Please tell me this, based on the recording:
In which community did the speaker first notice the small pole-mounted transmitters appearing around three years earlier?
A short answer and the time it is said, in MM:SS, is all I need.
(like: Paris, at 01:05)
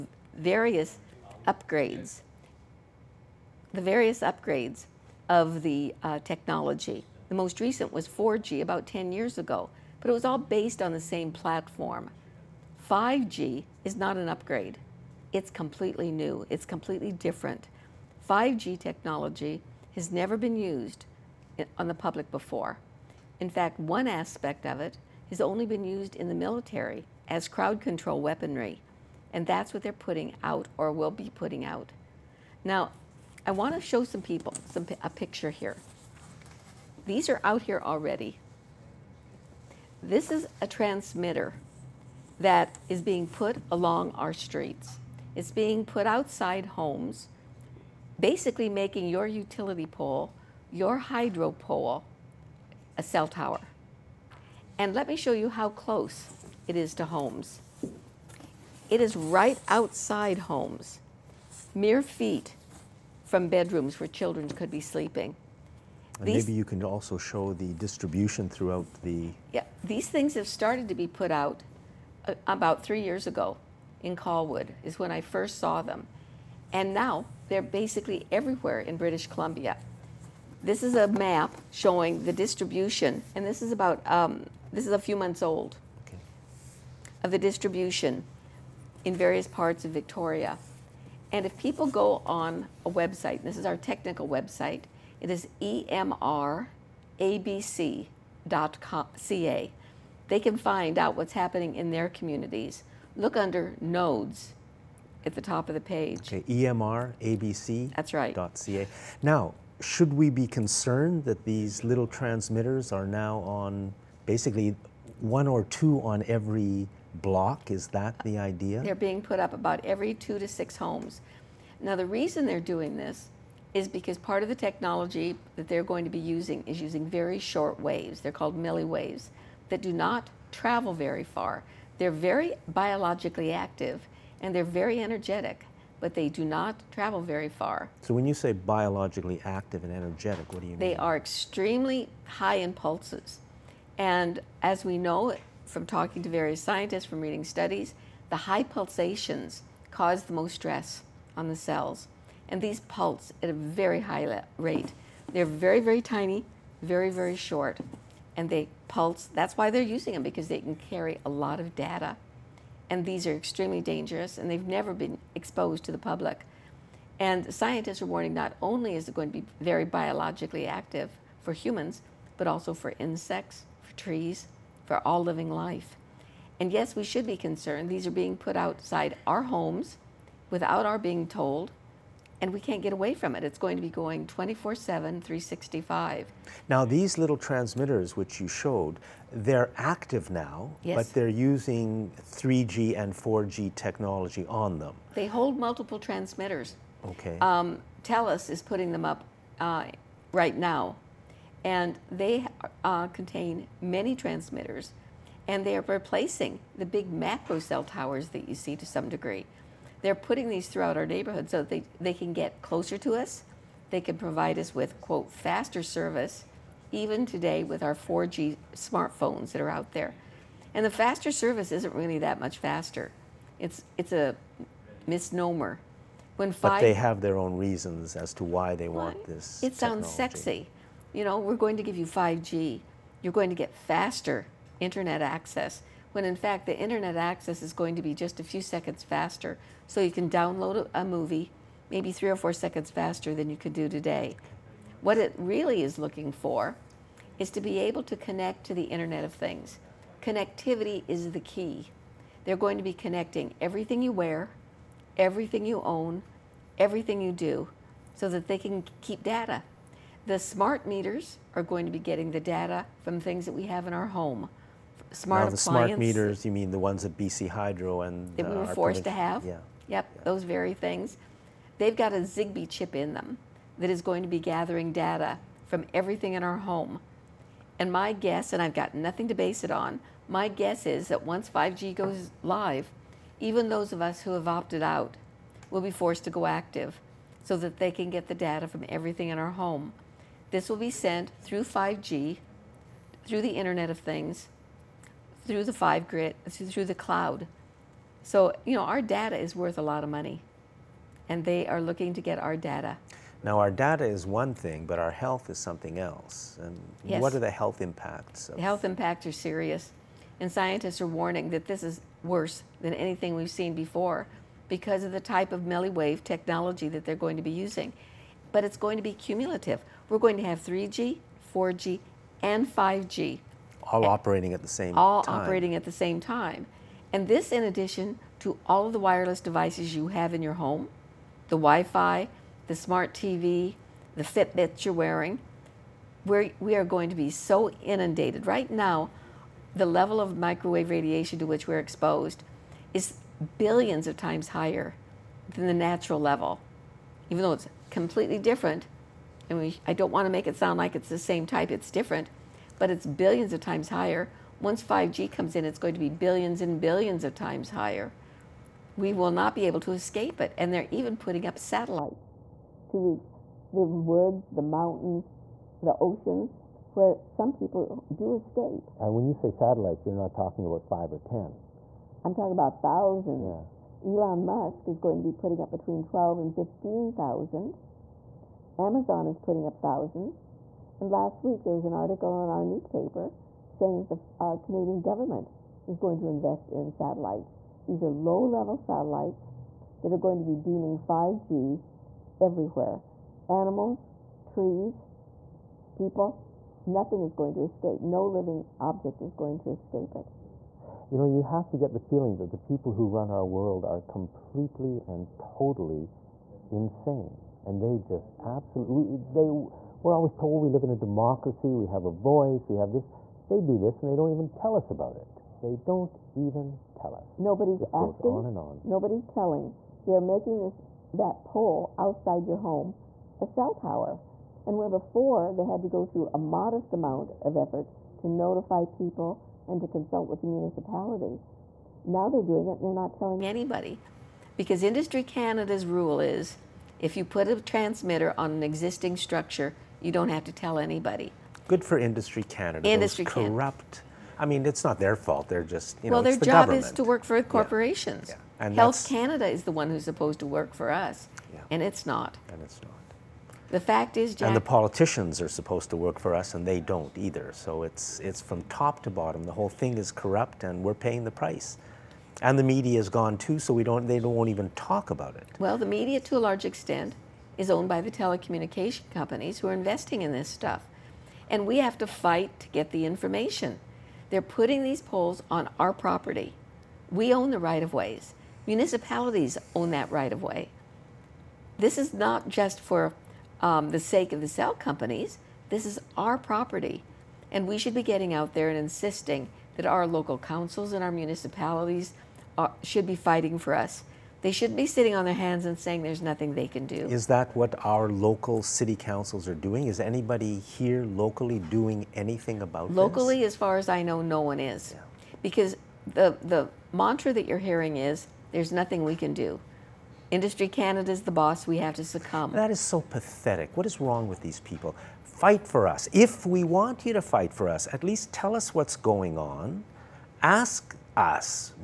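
Colwood, at 01:14.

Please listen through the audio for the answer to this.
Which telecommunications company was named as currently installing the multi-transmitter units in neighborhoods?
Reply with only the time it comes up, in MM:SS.
03:18.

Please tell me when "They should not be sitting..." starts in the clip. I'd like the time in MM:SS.
08:14.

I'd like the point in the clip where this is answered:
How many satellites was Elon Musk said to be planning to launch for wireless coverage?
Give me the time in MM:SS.
06:15.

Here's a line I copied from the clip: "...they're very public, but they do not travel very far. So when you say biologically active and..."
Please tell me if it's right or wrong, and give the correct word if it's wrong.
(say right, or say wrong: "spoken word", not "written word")
wrong: "energetic", not "public".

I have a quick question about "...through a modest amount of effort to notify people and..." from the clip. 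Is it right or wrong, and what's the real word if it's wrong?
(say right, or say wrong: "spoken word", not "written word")
right.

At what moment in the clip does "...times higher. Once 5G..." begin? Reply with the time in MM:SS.
05:53.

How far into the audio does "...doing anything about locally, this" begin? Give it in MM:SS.
08:21.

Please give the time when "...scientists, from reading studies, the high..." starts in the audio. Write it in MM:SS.
02:26.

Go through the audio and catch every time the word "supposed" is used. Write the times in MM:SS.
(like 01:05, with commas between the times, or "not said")
07:30, 07:35.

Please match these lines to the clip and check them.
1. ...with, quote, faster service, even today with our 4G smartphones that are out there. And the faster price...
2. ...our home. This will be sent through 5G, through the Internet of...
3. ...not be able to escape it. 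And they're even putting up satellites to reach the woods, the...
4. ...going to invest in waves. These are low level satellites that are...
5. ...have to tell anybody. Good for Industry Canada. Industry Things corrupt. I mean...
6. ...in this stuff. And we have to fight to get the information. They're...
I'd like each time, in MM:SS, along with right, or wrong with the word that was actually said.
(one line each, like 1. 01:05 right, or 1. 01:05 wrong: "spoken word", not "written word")
1. 03:34 wrong: "service", not "price"
2. 04:49 right
3. 05:59 right
4. 06:25 wrong: "satellites", not "waves"
5. 07:20 wrong: "Those", not "Things"
6. 07:50 right.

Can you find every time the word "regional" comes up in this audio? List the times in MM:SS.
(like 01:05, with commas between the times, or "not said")
not said.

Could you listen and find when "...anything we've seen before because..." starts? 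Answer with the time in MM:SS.
05:12.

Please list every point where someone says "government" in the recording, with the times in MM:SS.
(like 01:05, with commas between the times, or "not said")
06:25, 07:26.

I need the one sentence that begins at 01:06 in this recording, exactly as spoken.
These, maybe you can also show the distribution throughout the.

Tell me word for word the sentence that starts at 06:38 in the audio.
No living object is going to escape it.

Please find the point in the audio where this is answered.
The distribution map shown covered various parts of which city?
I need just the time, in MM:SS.
01:29.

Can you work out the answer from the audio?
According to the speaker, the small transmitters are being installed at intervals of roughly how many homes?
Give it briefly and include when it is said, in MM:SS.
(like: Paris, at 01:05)
2 to 6 homes, at 02:00.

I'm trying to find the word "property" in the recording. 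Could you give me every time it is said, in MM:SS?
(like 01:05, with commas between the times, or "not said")
07:55, 08:06.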